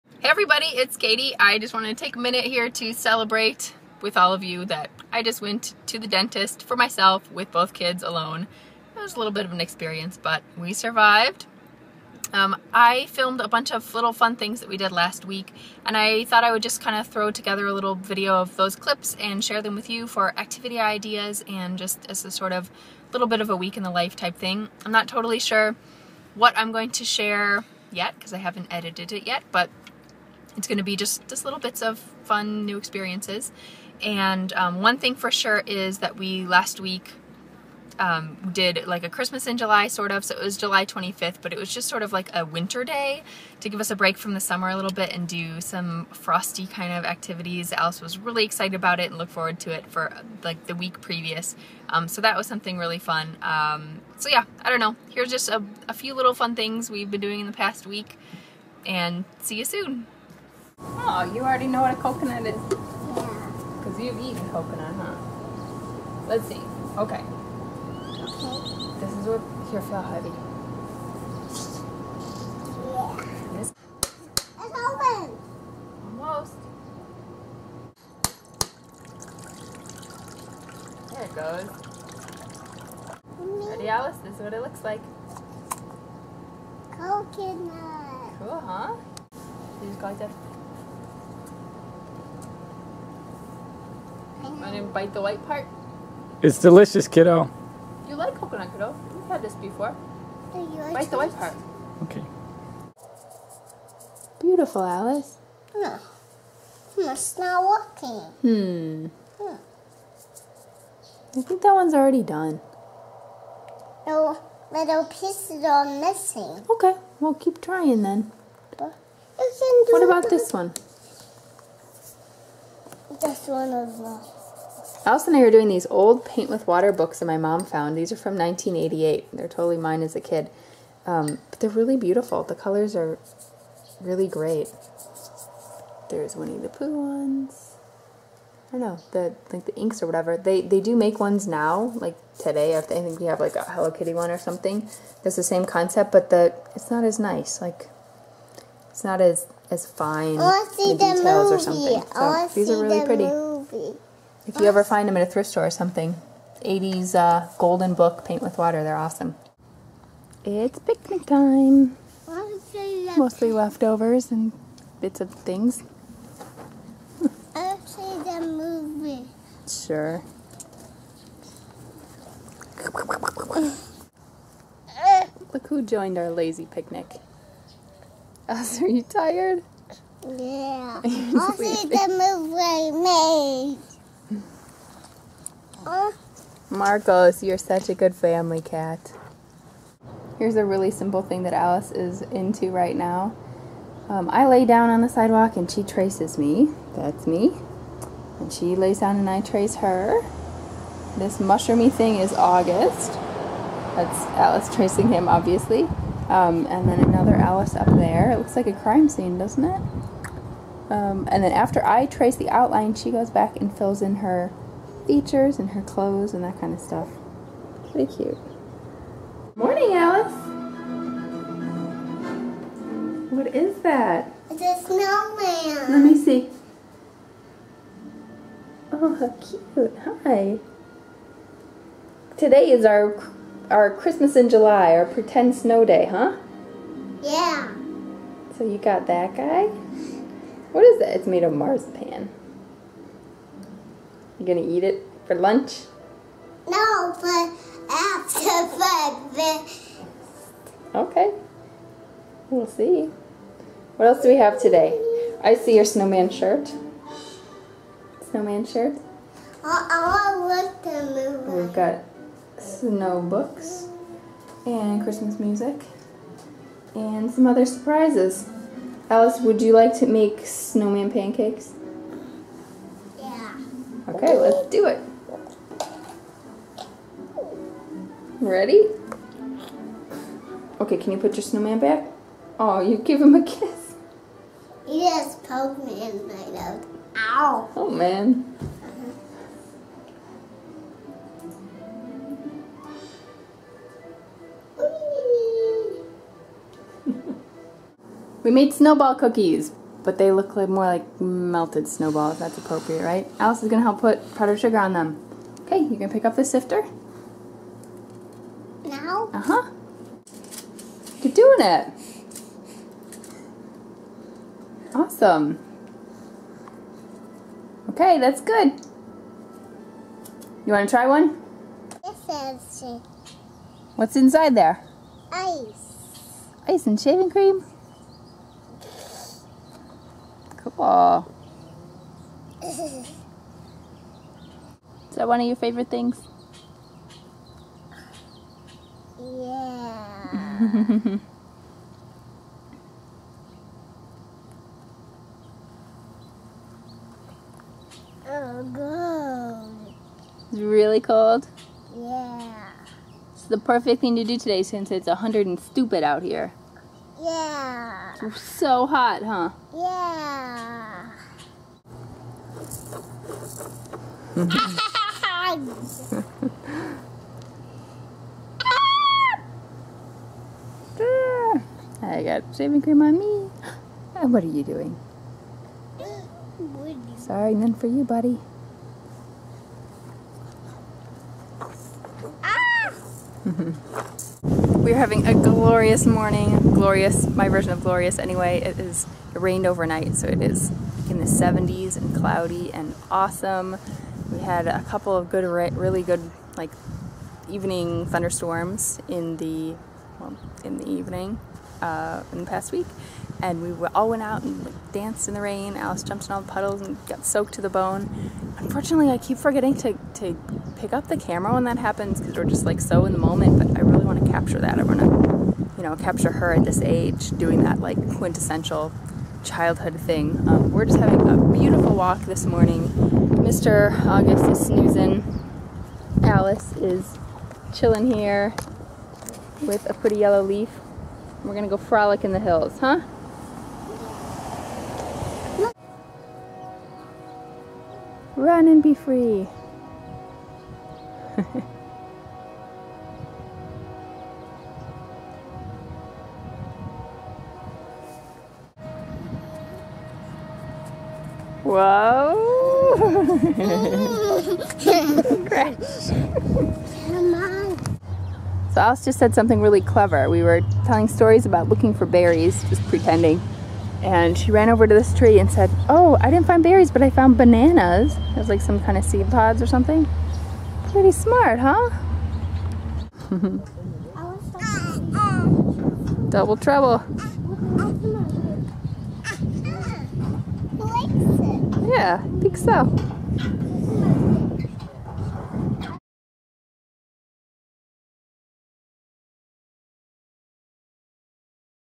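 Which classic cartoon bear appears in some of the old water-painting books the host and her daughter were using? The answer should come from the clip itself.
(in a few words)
Winnie the Pooh.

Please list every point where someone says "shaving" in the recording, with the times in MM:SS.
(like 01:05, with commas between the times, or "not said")
05:26, 06:12.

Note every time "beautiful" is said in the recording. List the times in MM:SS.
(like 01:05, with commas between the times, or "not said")
01:44, 02:11, 07:01.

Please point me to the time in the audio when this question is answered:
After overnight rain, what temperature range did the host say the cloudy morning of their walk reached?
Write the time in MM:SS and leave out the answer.
06:31.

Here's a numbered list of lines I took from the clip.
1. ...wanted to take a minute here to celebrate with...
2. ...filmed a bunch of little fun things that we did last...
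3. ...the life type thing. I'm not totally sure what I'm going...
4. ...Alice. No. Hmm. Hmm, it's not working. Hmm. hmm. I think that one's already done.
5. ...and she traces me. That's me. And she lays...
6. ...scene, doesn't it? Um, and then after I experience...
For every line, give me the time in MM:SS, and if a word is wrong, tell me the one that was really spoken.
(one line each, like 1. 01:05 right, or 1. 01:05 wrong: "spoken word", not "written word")
1. 00:01 right
2. 00:13 right
3. 00:23 right
4. 01:44 right
5. 03:15 right
6. 03:29 wrong: "trace", not "experience".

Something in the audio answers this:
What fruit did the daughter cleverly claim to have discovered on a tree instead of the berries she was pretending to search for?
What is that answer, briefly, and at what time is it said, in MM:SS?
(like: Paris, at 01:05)
Bananas, at 07:47.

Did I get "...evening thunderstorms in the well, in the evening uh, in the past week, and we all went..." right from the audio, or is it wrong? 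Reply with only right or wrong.
right.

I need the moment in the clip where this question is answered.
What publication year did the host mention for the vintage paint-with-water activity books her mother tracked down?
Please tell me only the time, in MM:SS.
02:08.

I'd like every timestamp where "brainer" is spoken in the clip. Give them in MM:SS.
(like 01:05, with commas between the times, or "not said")
not said.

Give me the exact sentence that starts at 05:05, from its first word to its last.
Okay, you can pick up the sifter.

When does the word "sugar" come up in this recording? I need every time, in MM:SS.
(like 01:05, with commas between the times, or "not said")
05:04.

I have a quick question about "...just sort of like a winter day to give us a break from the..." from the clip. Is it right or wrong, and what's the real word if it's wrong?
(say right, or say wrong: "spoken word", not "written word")
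right.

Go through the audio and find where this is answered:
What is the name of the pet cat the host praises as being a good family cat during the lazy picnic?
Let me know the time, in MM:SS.
03:06.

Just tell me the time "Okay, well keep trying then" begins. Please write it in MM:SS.
01:56.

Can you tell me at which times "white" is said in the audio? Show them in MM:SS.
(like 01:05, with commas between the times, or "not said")
01:35, 01:41.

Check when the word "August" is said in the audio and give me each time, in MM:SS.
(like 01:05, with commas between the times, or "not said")
03:22, 07:04.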